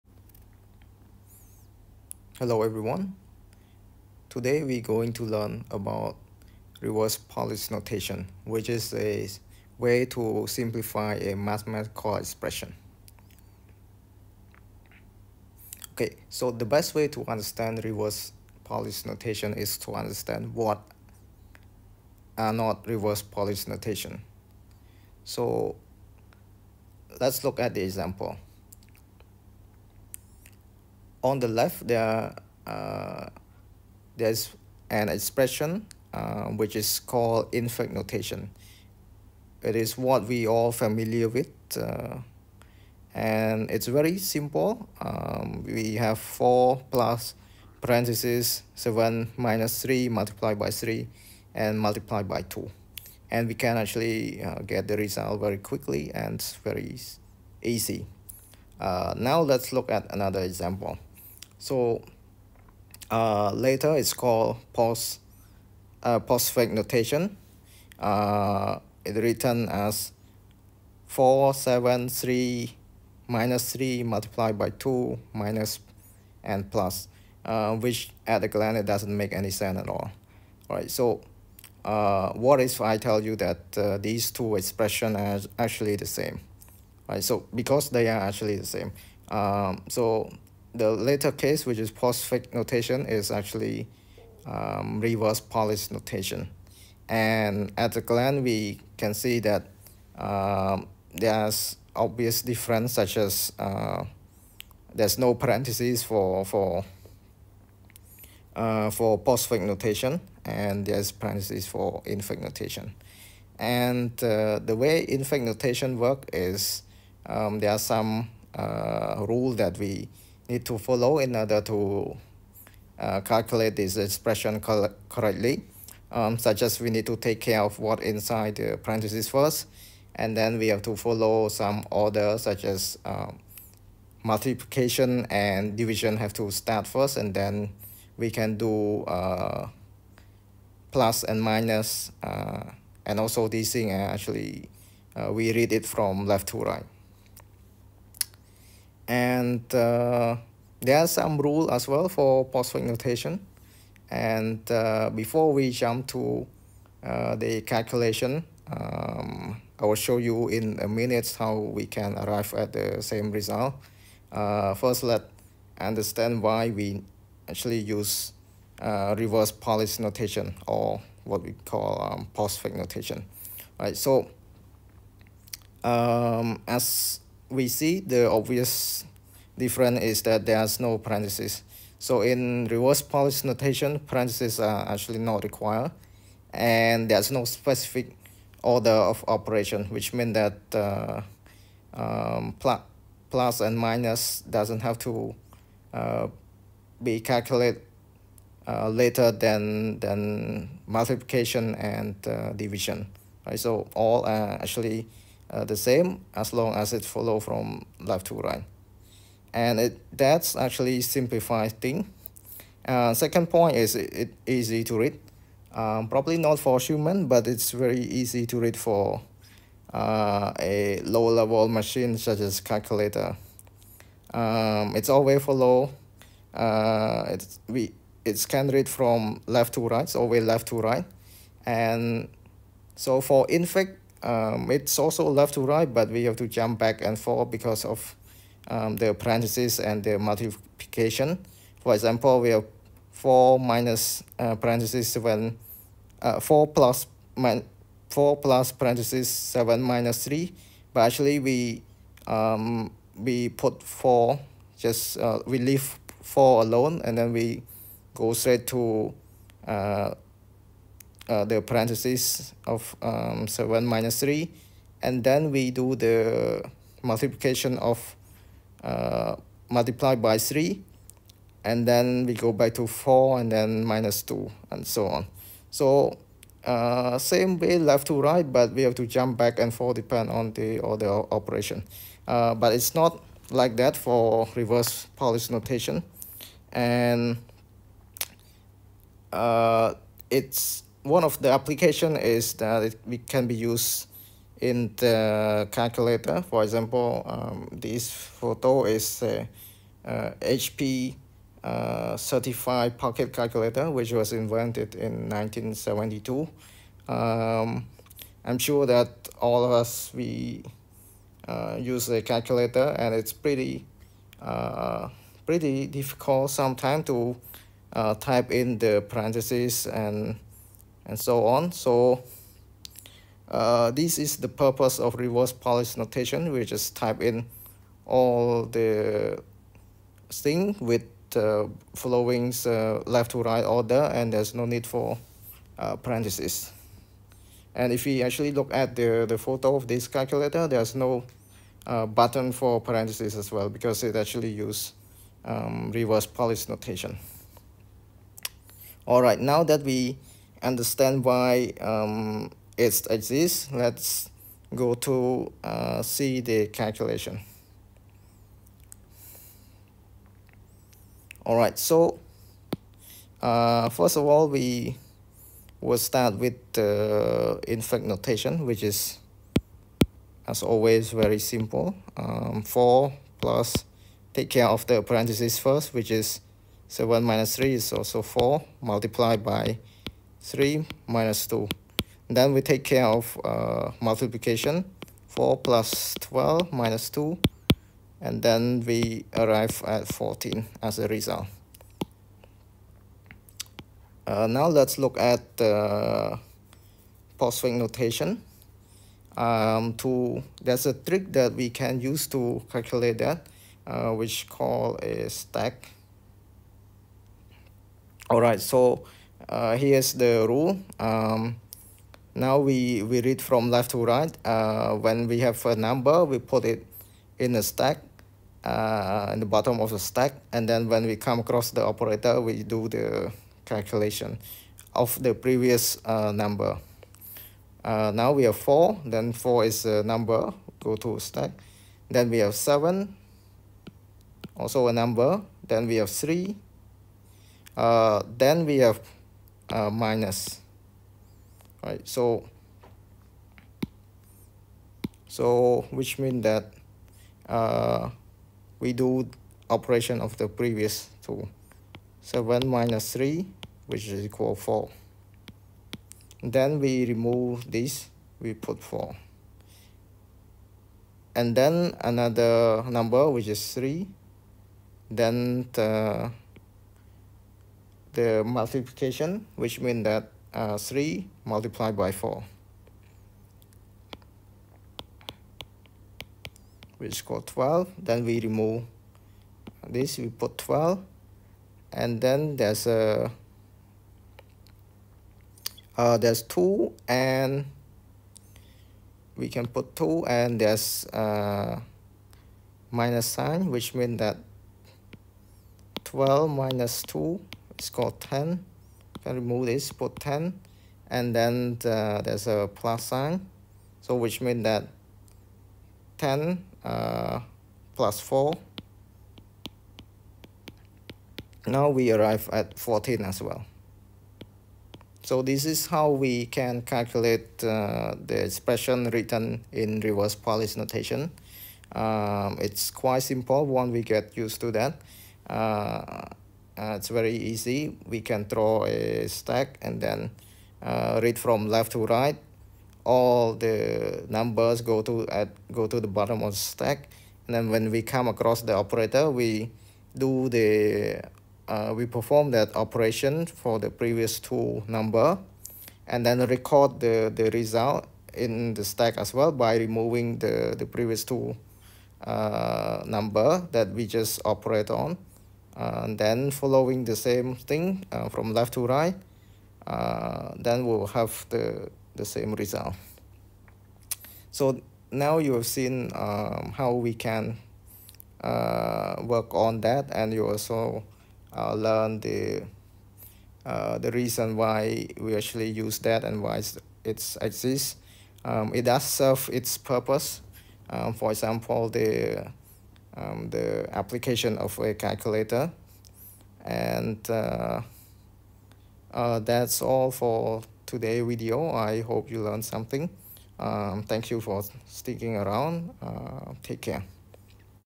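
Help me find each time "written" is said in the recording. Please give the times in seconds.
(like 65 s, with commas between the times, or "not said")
69 s, 519 s.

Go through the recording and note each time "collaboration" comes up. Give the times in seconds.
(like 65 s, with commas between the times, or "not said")
not said.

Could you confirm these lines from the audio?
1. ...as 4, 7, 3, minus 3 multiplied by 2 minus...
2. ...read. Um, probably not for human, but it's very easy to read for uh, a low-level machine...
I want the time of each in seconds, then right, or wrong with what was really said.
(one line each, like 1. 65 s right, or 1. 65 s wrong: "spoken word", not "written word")
1. 69 s right
2. 214 s right.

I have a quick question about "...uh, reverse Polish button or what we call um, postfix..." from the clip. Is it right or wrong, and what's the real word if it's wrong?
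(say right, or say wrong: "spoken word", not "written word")
wrong: "notation", not "button".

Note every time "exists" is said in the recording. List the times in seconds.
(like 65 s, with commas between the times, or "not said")
353 s, 577 s.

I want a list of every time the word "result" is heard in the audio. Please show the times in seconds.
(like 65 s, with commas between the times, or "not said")
54 s, 163 s, 391 s, 547 s, 562 s.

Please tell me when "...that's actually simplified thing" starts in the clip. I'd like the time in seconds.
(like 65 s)
210 s.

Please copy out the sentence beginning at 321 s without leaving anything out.
So uh, this is the purpose of reverse polish notation.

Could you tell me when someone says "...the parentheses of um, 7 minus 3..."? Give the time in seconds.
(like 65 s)
261 s.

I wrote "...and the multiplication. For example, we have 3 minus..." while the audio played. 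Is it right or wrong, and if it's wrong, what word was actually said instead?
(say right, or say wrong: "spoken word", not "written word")
wrong: "4", not "3".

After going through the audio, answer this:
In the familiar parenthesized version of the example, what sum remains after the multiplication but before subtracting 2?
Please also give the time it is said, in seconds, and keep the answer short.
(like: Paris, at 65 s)
4 plus 12, at 385 s.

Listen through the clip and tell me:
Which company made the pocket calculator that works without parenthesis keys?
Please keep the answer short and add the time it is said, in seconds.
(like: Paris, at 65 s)
HP, at 300 s.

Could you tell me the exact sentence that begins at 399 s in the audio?
Um, to There's a trick that we can use to calculate that, uh, which called a stack.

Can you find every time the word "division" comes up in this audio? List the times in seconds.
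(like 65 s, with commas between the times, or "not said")
135 s, 202 s.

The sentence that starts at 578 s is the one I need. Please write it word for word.
Um, it does serve its purpose.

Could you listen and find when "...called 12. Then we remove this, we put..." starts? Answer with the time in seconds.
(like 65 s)
477 s.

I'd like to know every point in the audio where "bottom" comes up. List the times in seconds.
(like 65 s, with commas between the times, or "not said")
419 s, 536 s.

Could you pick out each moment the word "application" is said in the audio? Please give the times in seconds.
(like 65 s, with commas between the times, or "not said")
291 s, 583 s.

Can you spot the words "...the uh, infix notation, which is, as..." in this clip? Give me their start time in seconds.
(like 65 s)
366 s.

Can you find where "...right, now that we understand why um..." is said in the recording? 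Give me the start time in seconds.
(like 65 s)
349 s.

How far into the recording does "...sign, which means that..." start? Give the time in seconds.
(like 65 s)
493 s.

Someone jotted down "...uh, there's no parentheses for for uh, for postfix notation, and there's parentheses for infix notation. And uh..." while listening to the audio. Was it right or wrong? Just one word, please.
right.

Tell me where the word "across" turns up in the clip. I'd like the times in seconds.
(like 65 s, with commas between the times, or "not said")
421 s, 538 s.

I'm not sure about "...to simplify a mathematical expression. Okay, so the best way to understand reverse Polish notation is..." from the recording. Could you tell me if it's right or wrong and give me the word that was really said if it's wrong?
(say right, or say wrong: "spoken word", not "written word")
right.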